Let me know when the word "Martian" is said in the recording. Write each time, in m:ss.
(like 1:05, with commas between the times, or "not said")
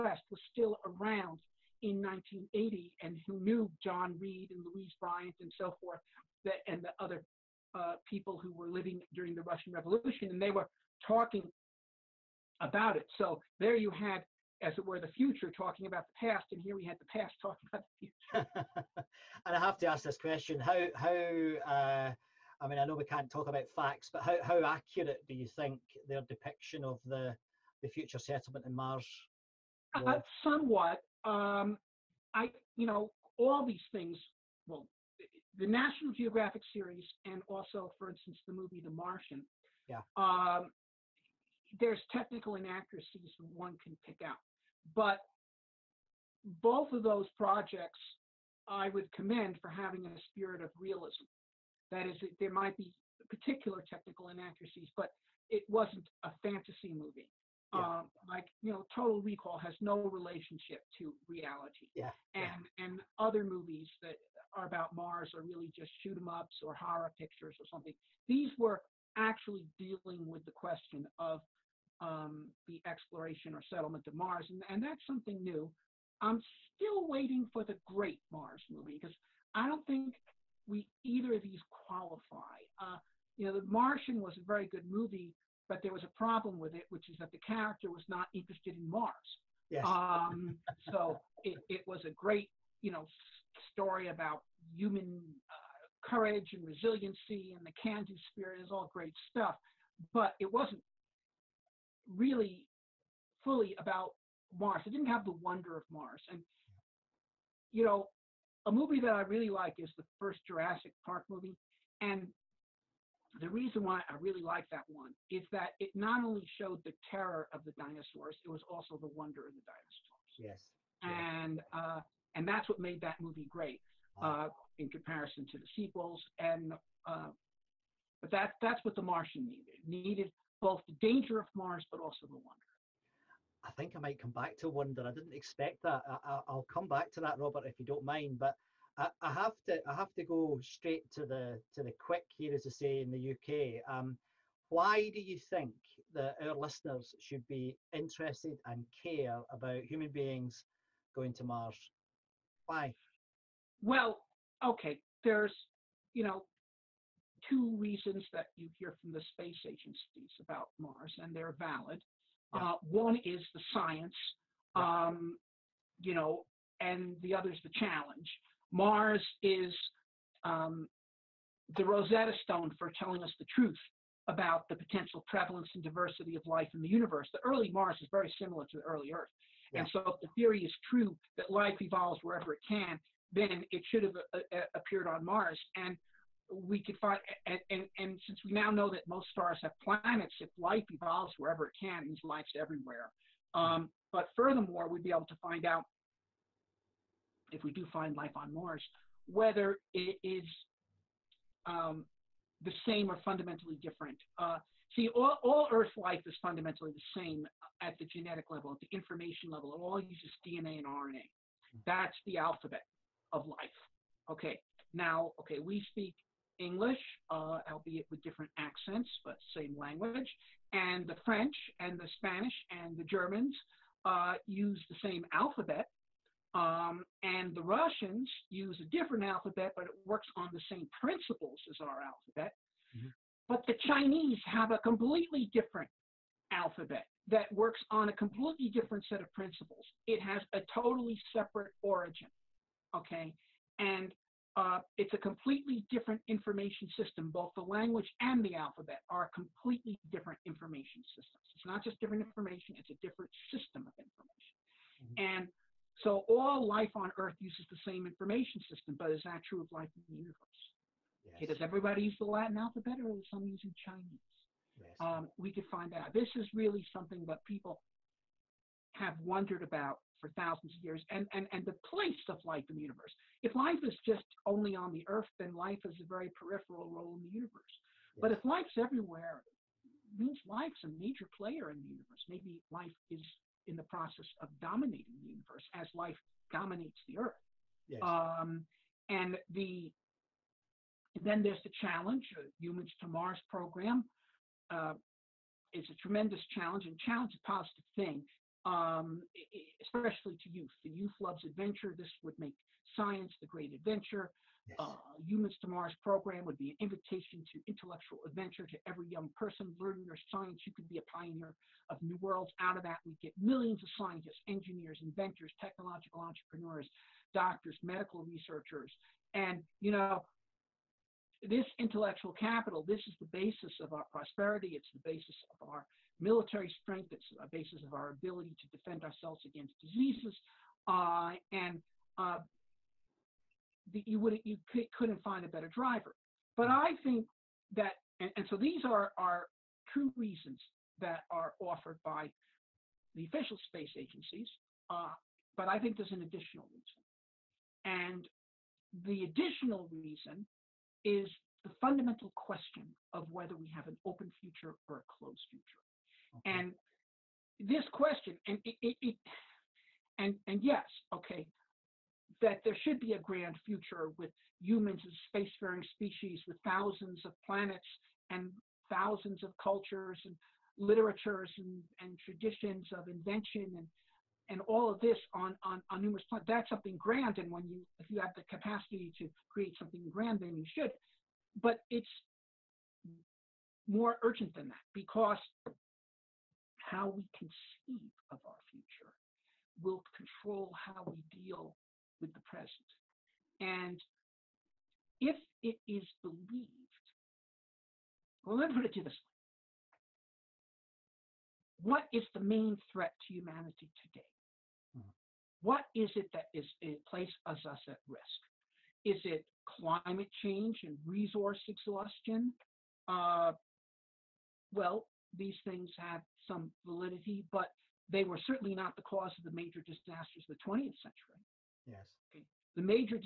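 0:38, 1:23, 2:09.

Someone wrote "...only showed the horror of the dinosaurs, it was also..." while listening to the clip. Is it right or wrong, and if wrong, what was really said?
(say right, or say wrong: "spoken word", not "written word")
wrong: "terror", not "horror".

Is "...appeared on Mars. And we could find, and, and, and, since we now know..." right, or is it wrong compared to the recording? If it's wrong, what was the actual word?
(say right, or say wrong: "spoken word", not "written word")
right.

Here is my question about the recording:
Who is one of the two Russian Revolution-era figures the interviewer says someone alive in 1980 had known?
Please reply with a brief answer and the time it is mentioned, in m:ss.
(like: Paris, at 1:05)
John Reed, at 0:03.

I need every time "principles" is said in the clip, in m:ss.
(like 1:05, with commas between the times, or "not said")
3:51, 3:59.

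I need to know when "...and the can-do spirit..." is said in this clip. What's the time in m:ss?
1:37.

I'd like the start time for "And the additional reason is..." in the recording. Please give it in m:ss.
5:47.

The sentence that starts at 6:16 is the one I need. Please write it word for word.
That's something grand, and when you if you have the capacity to create something grand, then you should.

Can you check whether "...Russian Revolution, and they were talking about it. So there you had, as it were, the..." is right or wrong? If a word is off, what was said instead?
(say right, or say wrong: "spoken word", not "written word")
right.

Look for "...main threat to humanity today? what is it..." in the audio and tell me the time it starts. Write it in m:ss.
6:42.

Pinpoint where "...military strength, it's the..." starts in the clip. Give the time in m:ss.
5:26.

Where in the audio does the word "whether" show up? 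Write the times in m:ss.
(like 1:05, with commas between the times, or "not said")
3:19, 5:53.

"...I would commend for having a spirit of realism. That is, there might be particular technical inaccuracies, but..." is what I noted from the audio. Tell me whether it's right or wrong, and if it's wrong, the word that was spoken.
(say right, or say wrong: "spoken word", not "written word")
right.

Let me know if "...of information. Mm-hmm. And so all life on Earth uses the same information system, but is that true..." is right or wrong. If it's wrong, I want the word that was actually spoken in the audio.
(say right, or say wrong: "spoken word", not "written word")
right.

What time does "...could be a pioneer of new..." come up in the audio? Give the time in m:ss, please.
5:10.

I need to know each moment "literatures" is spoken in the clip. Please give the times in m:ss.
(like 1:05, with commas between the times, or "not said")
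6:10.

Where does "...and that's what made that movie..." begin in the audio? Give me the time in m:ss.
2:02.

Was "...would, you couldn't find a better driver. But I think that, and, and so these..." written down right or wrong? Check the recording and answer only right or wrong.
right.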